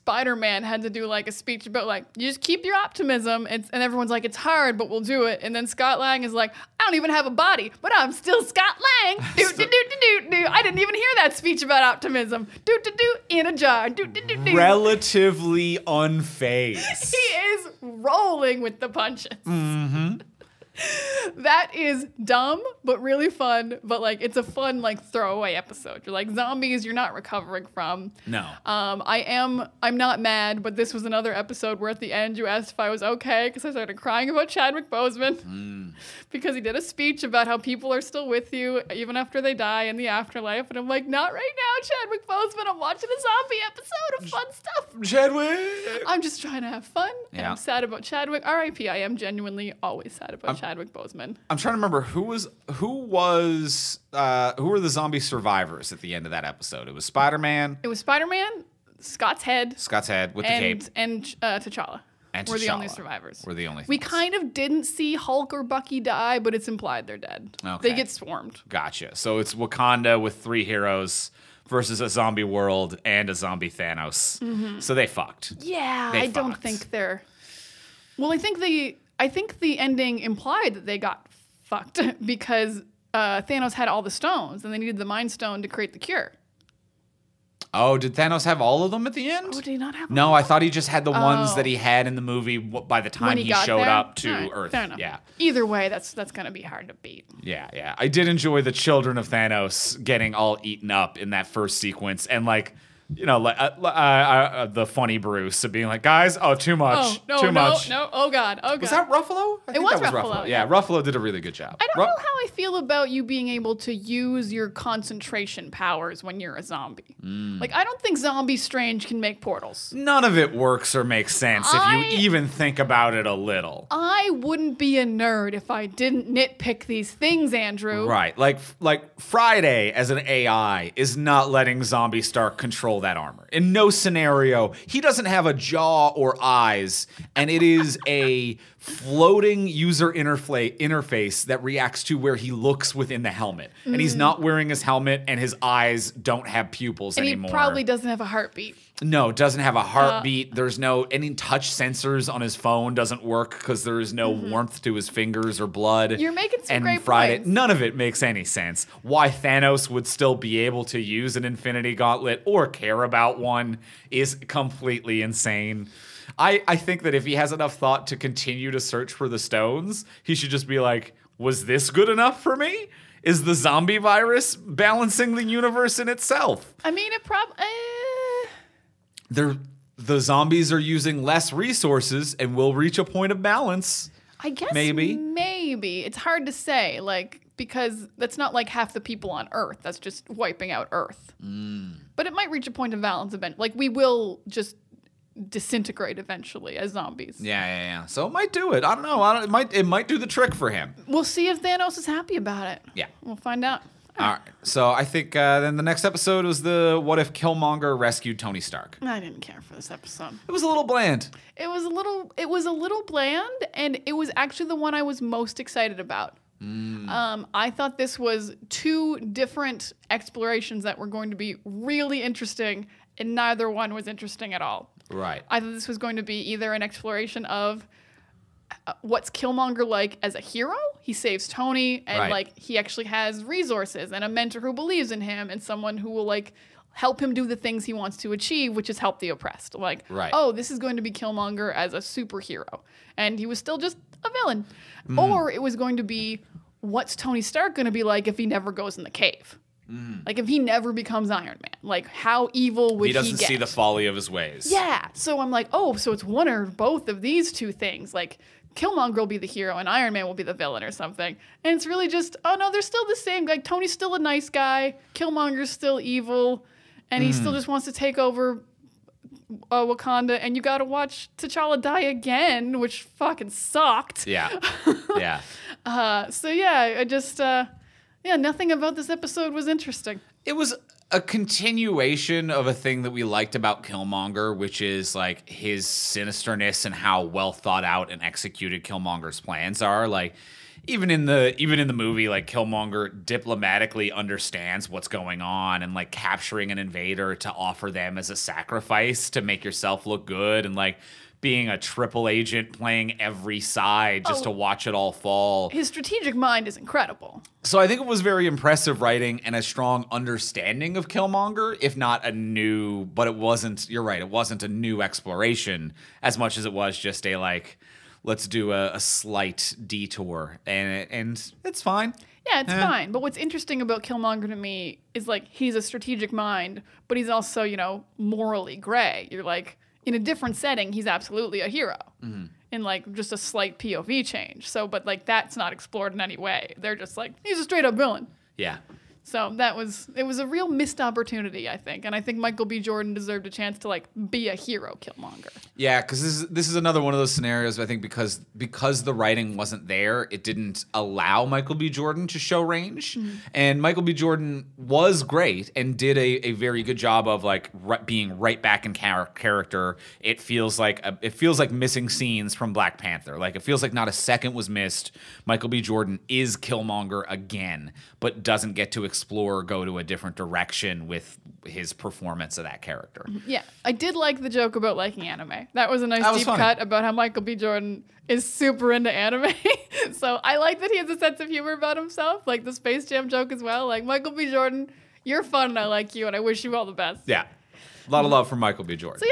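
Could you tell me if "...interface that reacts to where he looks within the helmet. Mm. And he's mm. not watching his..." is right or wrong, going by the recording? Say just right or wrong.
wrong.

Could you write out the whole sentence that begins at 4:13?
Doesn't he doesn't see the folly of his ways.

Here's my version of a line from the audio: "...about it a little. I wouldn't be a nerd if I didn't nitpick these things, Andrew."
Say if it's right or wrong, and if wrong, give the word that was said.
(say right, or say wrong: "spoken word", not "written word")
right.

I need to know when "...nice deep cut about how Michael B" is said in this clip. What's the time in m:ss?
6:16.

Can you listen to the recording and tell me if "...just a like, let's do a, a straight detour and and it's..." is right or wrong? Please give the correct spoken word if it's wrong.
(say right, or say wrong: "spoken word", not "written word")
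wrong: "slight", not "straight".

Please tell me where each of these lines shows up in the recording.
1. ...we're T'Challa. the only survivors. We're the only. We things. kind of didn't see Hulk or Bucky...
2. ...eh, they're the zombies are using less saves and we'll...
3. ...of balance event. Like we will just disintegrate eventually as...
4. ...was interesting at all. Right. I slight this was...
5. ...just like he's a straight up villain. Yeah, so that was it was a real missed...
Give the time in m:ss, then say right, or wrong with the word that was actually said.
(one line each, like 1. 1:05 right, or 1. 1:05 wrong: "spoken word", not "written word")
1. 1:02 right
2. 2:57 wrong: "resources", not "saves"
3. 3:12 right
4. 3:43 wrong: "thought", not "slight"
5. 5:36 right.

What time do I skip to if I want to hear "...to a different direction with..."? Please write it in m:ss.
6:09.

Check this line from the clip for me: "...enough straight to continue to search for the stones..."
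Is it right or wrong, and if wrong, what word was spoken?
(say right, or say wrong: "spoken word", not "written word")
wrong: "thought", not "straight".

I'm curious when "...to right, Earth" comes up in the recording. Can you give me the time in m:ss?
1:34.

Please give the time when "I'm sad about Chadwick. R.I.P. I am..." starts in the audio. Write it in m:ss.
0:47.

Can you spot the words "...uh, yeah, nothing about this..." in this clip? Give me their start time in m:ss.
4:37.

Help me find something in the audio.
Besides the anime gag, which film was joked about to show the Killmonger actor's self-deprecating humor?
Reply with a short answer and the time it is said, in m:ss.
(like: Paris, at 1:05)
Space Jam, at 6:22.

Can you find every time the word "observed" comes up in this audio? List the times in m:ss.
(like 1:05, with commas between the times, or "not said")
not said.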